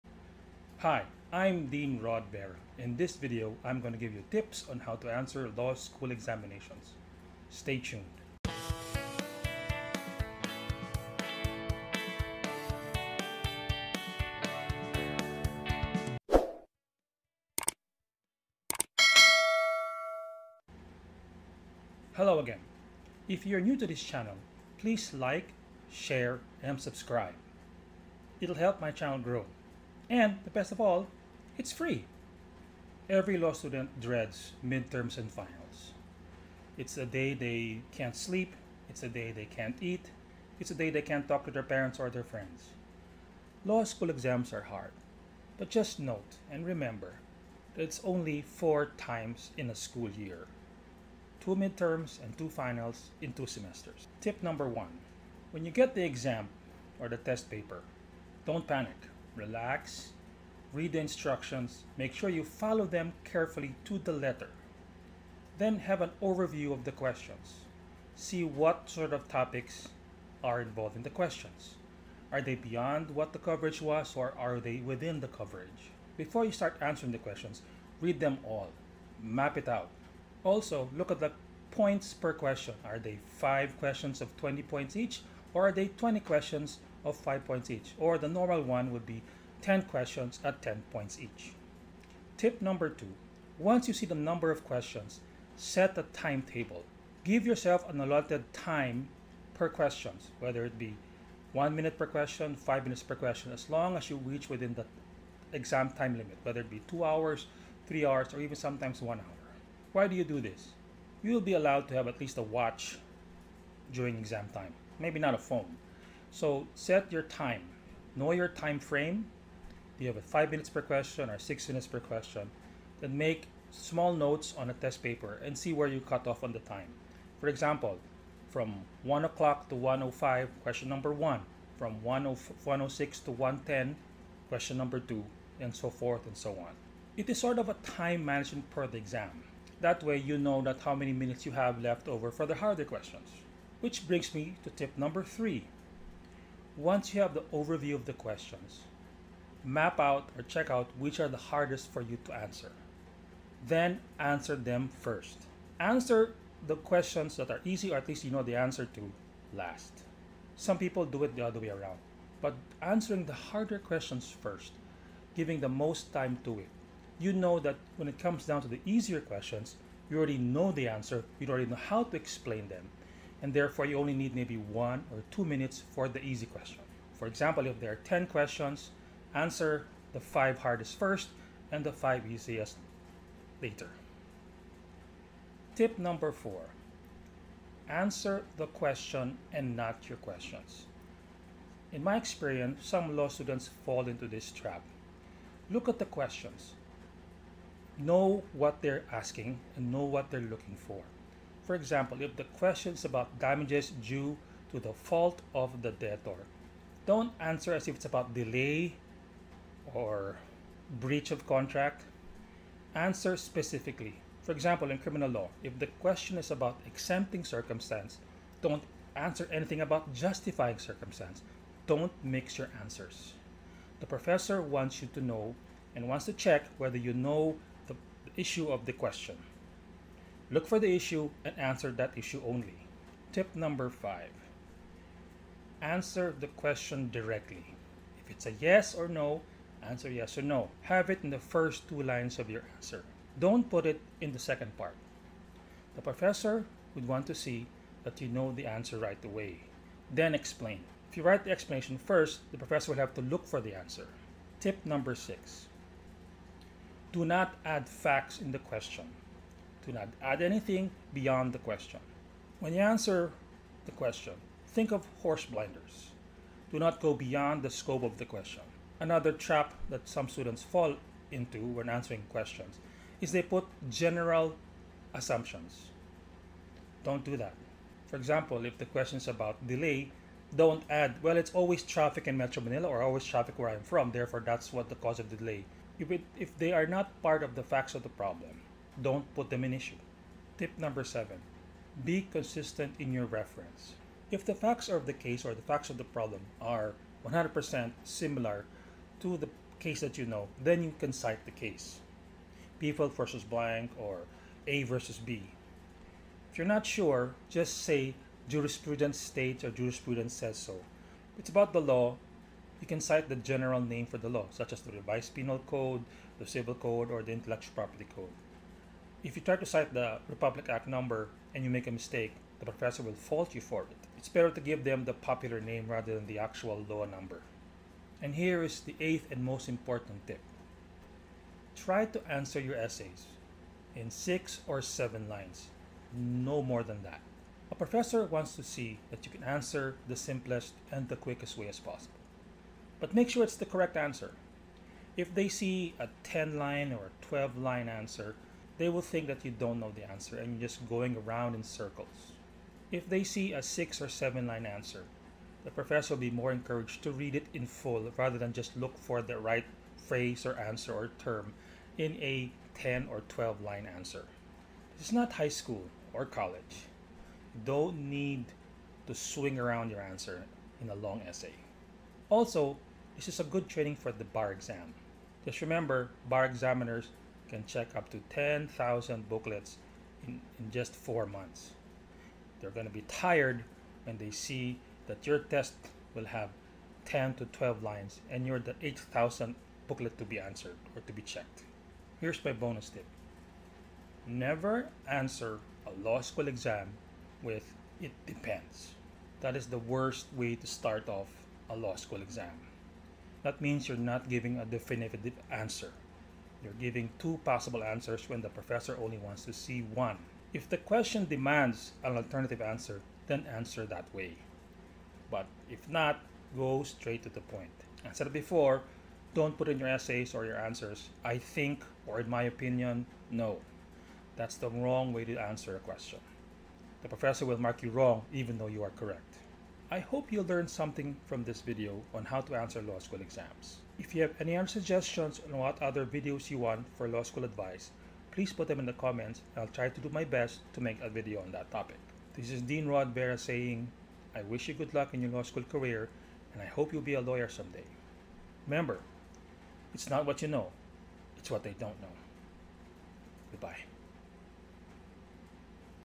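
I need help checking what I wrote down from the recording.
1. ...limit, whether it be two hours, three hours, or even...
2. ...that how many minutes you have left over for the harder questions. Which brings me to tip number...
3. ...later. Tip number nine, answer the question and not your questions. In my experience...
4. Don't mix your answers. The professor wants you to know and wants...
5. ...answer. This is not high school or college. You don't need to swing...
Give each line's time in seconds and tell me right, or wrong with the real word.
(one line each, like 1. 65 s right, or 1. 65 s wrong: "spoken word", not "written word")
1. 106 s right
2. 140 s right
3. 183 s wrong: "four", not "nine"
4. 221 s right
5. 363 s right.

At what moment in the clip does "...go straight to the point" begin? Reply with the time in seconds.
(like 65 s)
416 s.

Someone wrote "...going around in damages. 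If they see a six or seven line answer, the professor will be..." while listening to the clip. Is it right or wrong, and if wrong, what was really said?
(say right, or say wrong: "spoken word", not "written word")
wrong: "circles", not "damages".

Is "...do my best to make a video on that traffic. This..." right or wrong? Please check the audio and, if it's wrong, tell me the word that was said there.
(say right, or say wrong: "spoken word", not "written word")
wrong: "topic", not "traffic".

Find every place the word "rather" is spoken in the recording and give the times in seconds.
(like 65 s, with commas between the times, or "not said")
325 s, 358 s.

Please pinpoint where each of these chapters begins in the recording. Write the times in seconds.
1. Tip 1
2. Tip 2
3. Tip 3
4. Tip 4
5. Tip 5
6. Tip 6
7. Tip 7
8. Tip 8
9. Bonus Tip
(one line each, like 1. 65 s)
1. 66 s
2. 95 s
3. 153 s
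4. 186 s
5. 235 s
6. 255 s
7. 291 s
8. 330 s
9. 392 s.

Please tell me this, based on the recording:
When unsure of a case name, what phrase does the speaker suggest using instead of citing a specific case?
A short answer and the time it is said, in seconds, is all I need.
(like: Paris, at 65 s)
jurisprudence states, at 308 s.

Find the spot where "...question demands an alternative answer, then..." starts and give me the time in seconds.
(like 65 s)
410 s.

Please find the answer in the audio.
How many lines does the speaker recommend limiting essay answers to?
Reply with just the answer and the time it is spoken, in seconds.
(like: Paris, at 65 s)
six or seven lines, at 334 s.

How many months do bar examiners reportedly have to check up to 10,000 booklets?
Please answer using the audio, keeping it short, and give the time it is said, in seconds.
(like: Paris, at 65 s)
4, at 380 s.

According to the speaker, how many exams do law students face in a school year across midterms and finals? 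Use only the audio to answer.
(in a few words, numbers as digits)
4.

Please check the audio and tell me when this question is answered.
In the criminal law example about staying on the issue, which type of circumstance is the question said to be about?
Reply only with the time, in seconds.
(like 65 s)
216 s.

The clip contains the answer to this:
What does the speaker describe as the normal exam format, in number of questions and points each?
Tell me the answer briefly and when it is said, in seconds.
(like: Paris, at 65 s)
10 questions at 10 points each, at 89 s.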